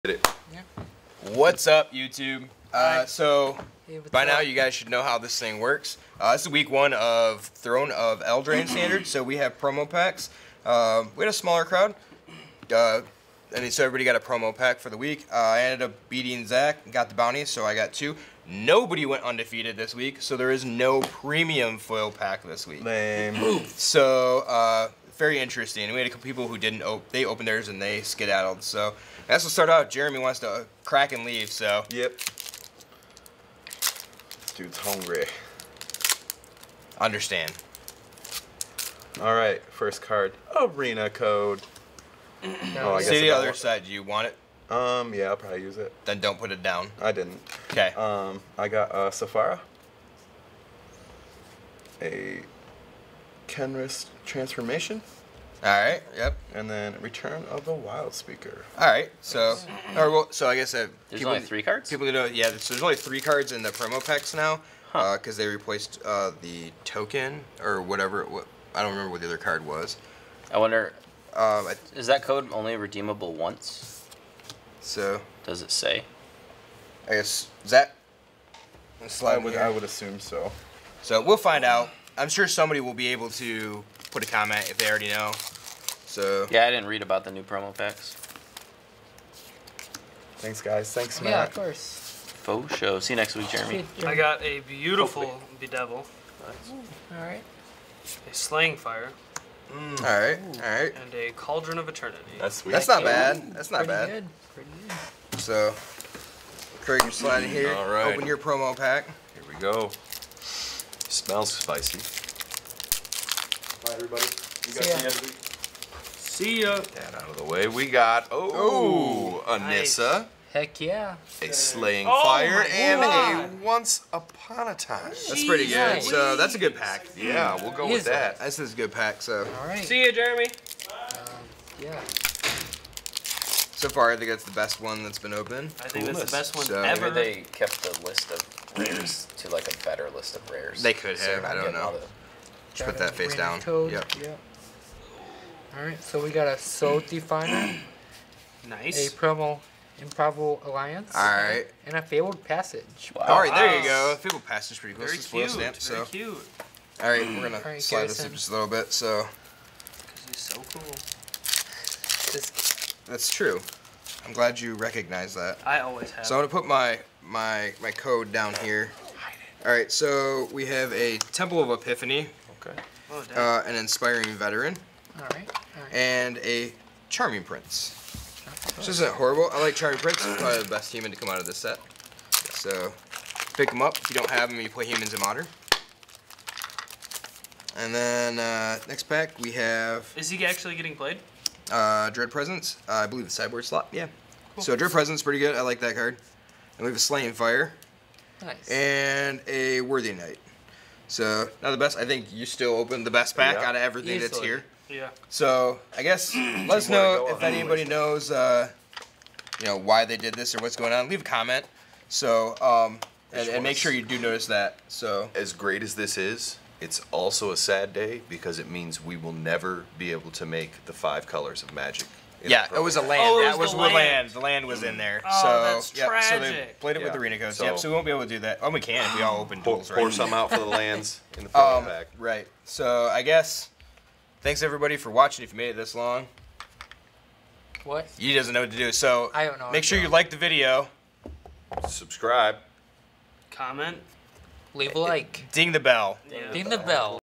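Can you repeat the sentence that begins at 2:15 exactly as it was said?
I think cool that's the best one so, ever.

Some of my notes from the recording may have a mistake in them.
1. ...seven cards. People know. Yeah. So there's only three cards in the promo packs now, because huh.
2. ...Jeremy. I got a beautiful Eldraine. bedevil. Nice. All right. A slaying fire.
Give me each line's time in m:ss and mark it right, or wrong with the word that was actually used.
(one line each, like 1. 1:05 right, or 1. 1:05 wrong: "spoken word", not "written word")
1. 1:01 wrong: "three", not "seven"
2. 1:33 wrong: "Hopefully", not "Eldraine".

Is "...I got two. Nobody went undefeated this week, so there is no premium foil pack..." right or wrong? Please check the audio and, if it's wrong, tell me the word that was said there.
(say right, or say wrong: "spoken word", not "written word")
right.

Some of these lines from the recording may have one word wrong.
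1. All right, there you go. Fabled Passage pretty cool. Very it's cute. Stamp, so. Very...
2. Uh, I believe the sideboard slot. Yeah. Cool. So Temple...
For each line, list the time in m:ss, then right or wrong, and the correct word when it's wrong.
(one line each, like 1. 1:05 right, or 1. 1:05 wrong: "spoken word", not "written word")
1. 2:33 right
2. 3:12 wrong: "Dread", not "Temple".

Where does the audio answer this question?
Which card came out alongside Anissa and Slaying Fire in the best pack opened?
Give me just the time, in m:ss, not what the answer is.
2:03.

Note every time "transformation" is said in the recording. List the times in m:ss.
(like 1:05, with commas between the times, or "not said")
0:54.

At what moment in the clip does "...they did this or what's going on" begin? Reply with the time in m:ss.
3:30.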